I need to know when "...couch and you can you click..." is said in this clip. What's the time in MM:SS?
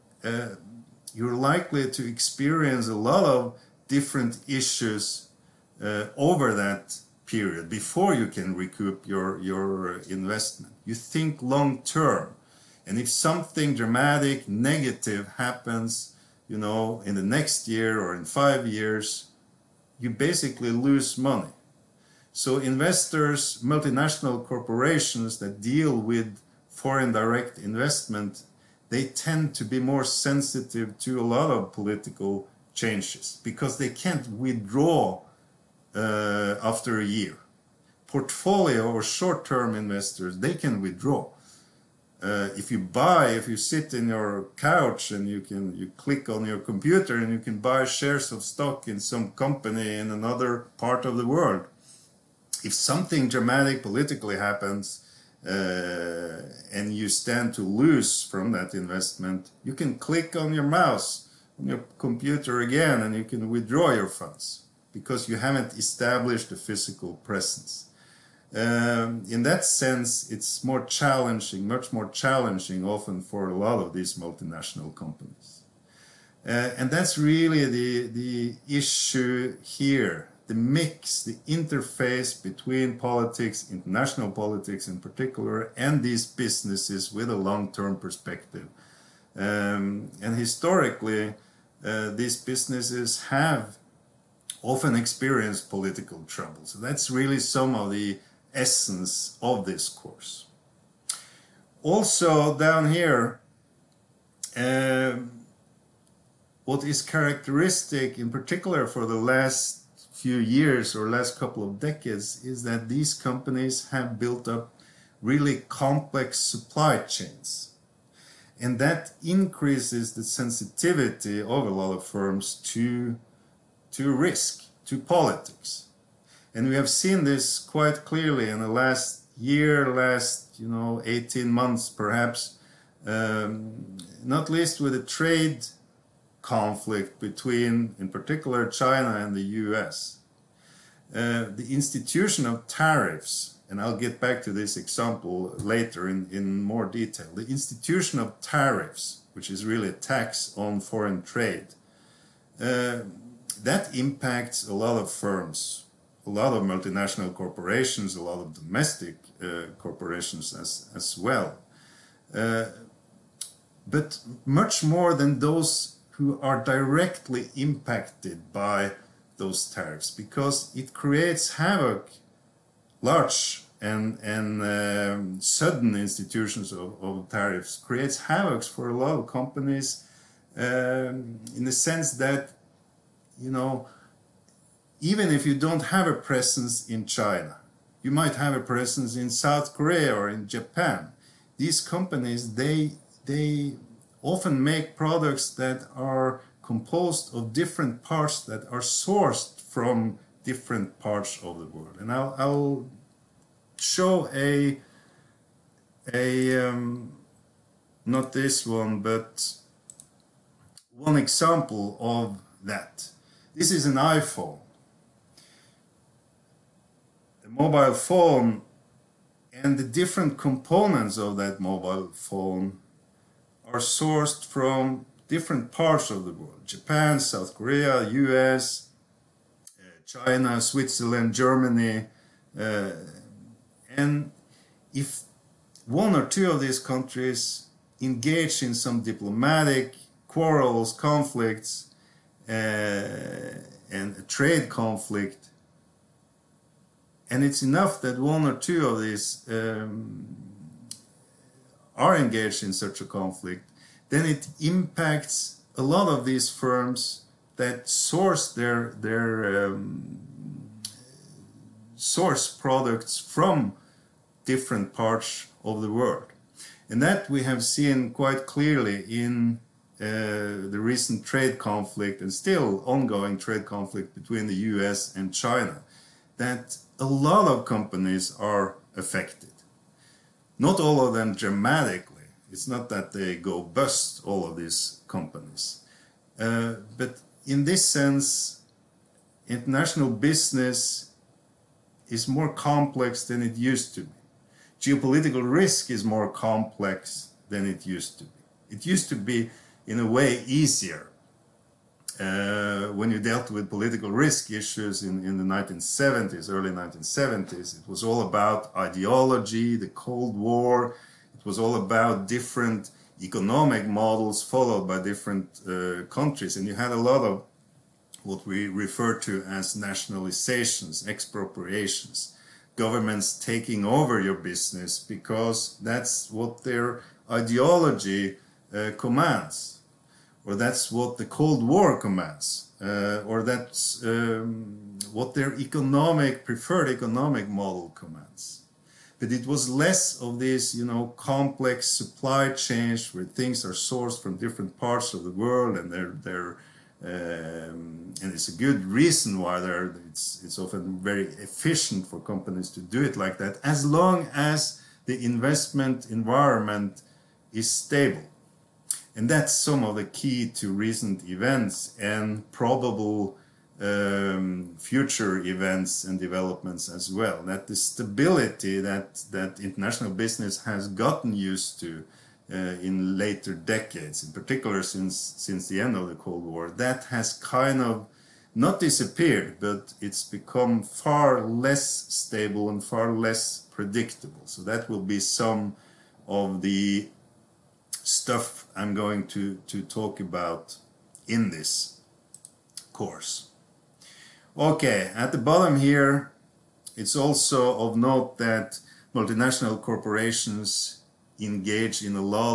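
00:44.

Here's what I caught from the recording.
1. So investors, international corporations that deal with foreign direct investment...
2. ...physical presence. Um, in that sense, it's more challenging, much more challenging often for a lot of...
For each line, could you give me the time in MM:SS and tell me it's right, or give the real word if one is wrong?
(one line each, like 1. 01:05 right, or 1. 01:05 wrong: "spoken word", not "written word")
1. 00:22 wrong: "multinational", not "international"
2. 01:06 right.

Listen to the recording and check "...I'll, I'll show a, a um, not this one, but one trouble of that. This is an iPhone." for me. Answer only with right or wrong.
wrong.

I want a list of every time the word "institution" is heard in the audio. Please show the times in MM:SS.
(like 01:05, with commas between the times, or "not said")
02:21, 02:27, 02:55.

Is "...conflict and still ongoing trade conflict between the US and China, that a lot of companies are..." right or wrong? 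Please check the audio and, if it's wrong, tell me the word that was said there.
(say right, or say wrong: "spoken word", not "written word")
right.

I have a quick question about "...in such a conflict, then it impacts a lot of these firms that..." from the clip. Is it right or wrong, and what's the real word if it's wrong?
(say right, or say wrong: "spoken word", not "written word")
right.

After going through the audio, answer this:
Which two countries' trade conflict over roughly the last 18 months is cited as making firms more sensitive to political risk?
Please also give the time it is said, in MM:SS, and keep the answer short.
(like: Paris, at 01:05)
China and the US, at 02:18.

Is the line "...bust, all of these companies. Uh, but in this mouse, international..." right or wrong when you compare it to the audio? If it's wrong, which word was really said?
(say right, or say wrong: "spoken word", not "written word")
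wrong: "sense", not "mouse".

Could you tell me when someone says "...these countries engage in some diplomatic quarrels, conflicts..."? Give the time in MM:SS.
03:56.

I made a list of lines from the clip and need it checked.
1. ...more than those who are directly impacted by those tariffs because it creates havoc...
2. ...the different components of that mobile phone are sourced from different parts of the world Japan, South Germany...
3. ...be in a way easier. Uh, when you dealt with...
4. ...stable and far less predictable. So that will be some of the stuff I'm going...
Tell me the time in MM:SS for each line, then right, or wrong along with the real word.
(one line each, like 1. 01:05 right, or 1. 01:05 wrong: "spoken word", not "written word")
1. 02:44 right
2. 03:39 wrong: "Korea", not "Germany"
3. 04:59 right
4. 06:21 right.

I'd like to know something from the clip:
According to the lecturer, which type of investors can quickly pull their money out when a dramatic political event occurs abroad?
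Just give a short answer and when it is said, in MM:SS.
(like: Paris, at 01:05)
Portfolio or short-term investors, at 00:38.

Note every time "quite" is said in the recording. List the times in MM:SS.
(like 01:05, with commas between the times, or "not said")
02:07, 04:28.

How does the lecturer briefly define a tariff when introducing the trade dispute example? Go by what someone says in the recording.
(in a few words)
a tax on foreign trade.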